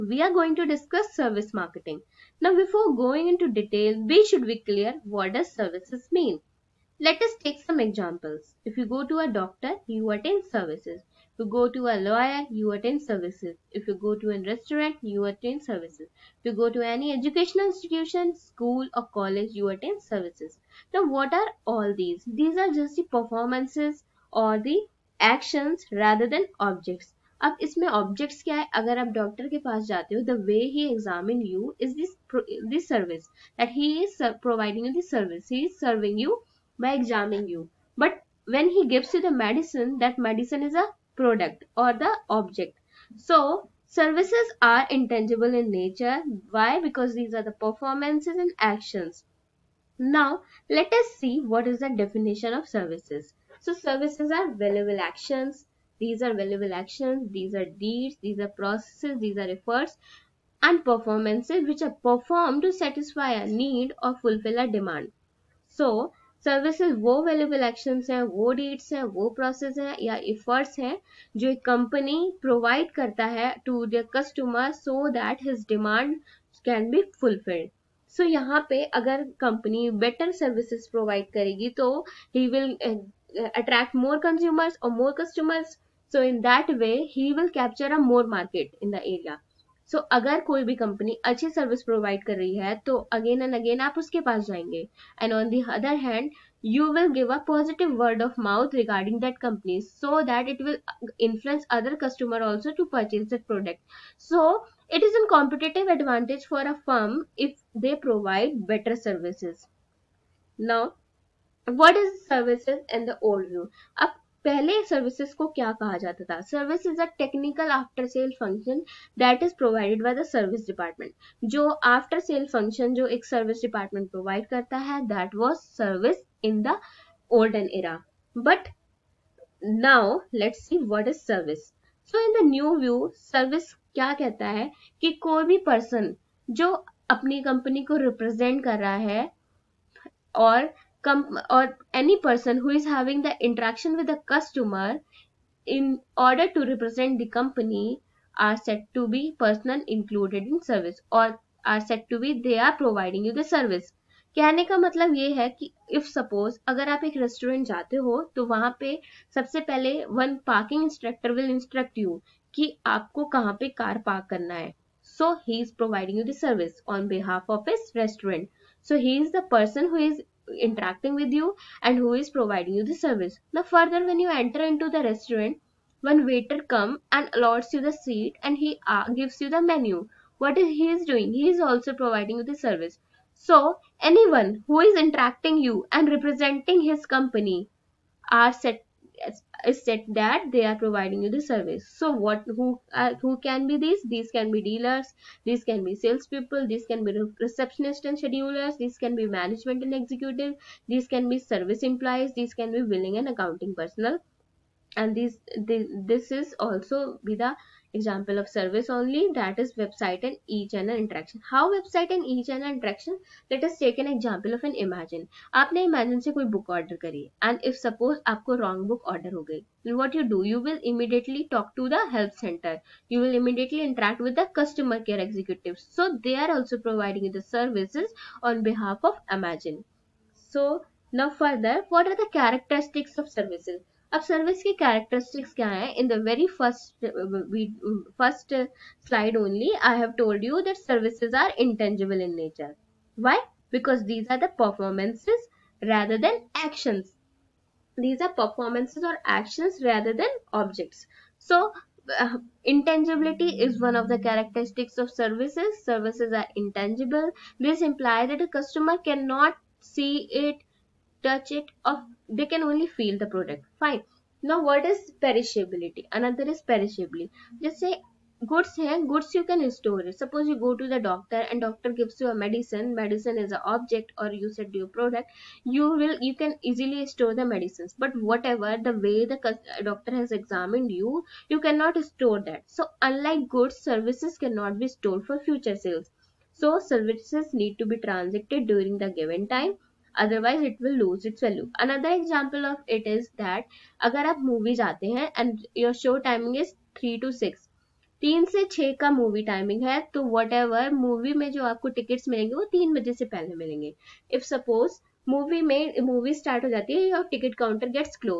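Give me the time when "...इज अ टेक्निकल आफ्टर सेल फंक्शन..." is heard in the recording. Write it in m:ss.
1:56.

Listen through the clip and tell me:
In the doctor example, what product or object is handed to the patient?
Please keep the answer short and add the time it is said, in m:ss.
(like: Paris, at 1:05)
Medicine, at 0:39.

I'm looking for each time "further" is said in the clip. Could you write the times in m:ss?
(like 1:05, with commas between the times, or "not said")
2:53, 3:51.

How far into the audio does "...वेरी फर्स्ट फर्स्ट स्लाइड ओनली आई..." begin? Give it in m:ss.
3:56.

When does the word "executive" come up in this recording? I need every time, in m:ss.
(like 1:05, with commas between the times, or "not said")
3:19, 3:45.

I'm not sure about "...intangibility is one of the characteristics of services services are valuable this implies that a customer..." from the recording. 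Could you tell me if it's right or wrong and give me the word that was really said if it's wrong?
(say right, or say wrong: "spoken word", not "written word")
wrong: "intangible", not "valuable".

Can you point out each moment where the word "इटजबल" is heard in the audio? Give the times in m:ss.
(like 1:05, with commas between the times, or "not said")
0:44, 4:01.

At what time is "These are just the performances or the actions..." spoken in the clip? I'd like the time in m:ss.
0:22.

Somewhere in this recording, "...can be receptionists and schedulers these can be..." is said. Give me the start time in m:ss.
3:16.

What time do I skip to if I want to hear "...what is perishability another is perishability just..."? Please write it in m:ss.
4:24.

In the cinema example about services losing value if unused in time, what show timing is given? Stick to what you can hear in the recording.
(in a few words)
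3 to 6.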